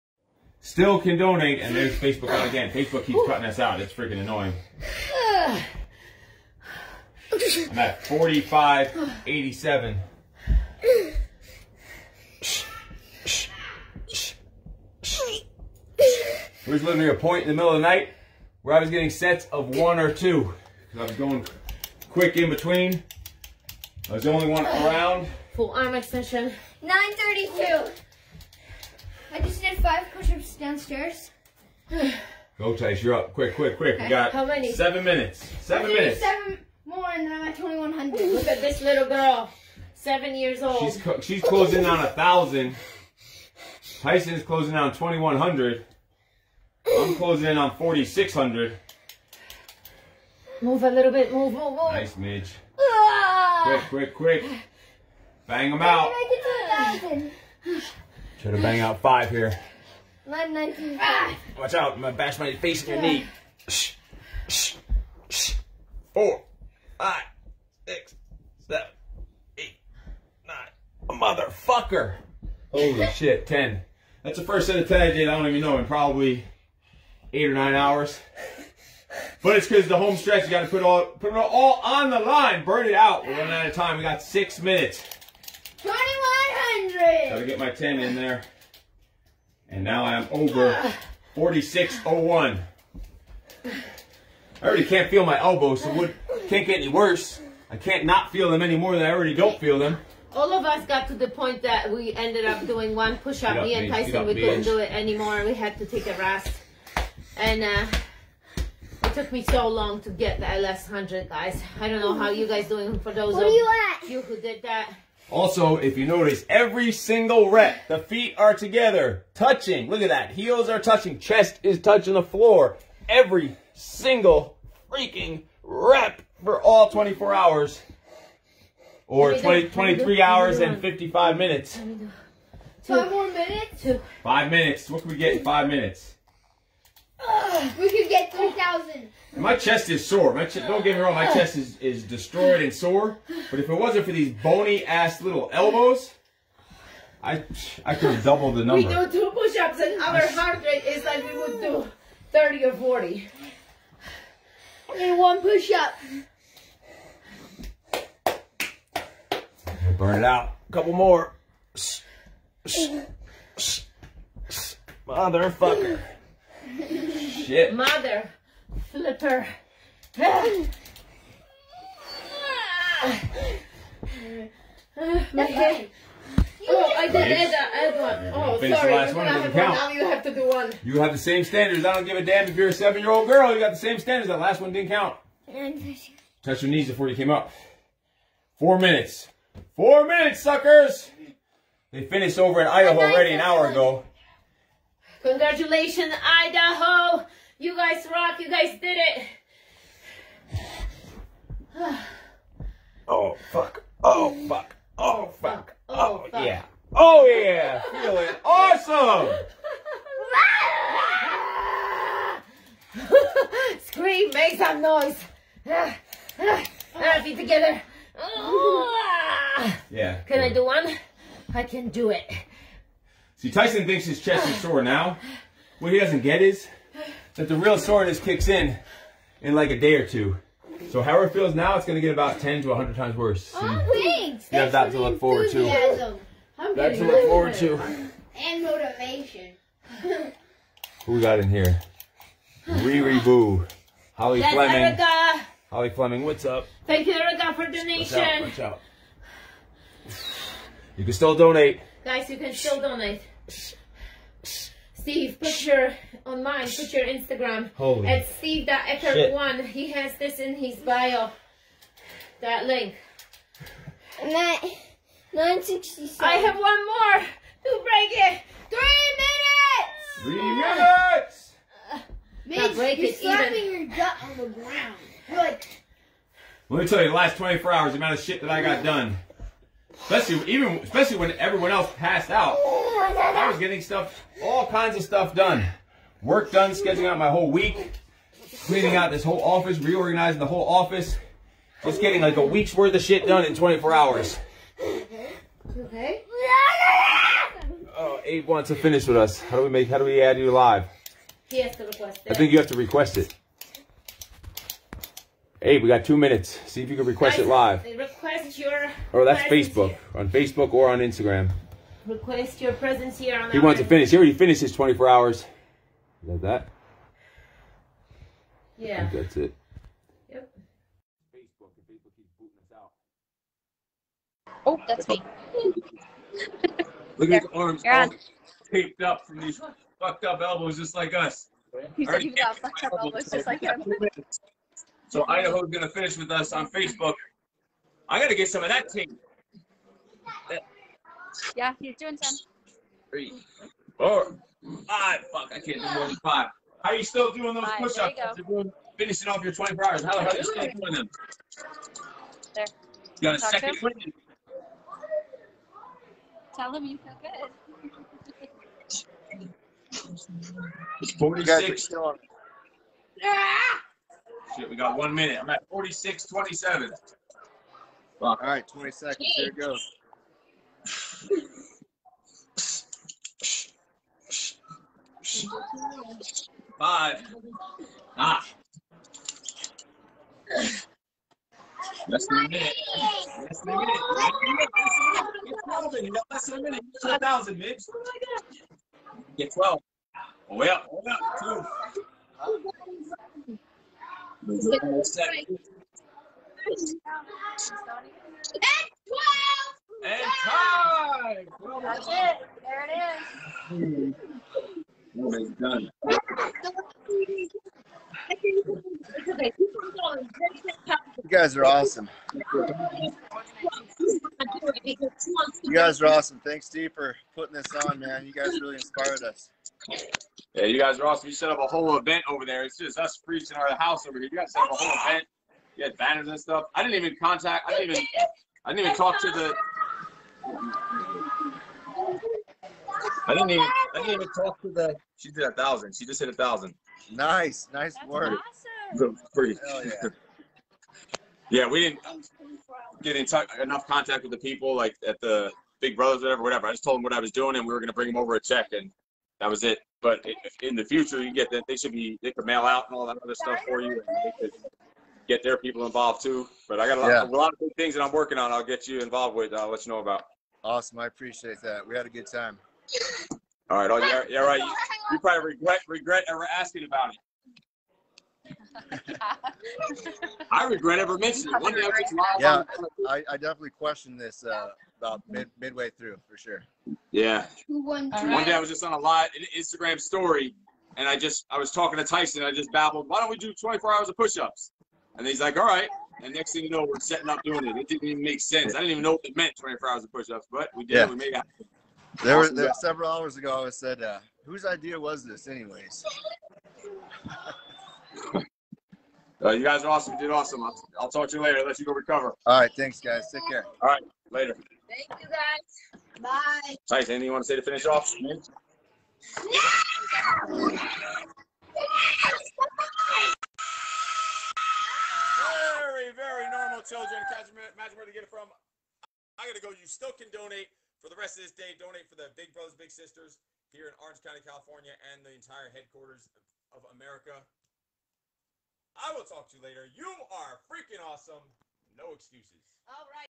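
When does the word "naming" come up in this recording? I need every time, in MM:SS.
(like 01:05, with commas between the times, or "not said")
not said.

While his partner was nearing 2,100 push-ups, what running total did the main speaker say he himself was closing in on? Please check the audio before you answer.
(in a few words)
4,600.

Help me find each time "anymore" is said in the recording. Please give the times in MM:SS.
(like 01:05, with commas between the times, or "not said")
01:38, 01:44.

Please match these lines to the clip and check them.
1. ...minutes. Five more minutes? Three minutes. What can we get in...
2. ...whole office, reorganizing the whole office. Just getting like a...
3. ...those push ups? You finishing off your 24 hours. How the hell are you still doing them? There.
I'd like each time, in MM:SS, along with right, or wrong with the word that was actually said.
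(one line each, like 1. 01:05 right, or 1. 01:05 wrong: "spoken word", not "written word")
1. 02:11 wrong: "Five", not "Three"
2. 04:49 right
3. 05:47 right.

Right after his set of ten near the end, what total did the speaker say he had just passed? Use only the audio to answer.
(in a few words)
4,601.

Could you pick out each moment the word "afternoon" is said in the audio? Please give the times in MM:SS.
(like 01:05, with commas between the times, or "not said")
not said.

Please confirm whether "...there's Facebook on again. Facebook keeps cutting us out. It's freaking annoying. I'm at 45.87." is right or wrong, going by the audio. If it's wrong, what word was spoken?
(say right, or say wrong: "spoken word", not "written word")
right.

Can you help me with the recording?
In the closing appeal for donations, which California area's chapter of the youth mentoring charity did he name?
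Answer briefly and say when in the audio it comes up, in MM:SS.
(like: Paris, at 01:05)
Orange County, at 08:44.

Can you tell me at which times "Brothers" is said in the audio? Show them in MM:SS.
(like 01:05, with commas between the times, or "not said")
07:25, 08:42.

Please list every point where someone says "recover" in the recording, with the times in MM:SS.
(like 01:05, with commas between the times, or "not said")
08:21.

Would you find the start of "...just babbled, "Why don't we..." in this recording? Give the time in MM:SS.
08:02.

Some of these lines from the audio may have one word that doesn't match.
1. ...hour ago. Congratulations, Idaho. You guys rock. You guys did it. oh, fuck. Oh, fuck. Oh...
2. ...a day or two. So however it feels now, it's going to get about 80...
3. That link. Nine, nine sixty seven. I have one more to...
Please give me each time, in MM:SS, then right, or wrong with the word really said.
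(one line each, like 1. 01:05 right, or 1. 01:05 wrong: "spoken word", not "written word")
1. 03:13 right
2. 03:49 wrong: "10", not "80"
3. 04:22 right.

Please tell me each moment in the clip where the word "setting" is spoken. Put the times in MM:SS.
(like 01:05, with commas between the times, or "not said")
08:06.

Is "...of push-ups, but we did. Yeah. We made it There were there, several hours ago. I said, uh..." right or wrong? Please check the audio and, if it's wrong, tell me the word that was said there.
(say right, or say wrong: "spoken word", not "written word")
right.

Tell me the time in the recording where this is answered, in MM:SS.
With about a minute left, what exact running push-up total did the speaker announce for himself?
06:05.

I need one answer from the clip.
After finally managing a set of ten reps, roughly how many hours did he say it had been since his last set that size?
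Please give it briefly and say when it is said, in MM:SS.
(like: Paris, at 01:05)
8 or 9 hours, at 01:17.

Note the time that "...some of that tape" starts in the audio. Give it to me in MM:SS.
05:38.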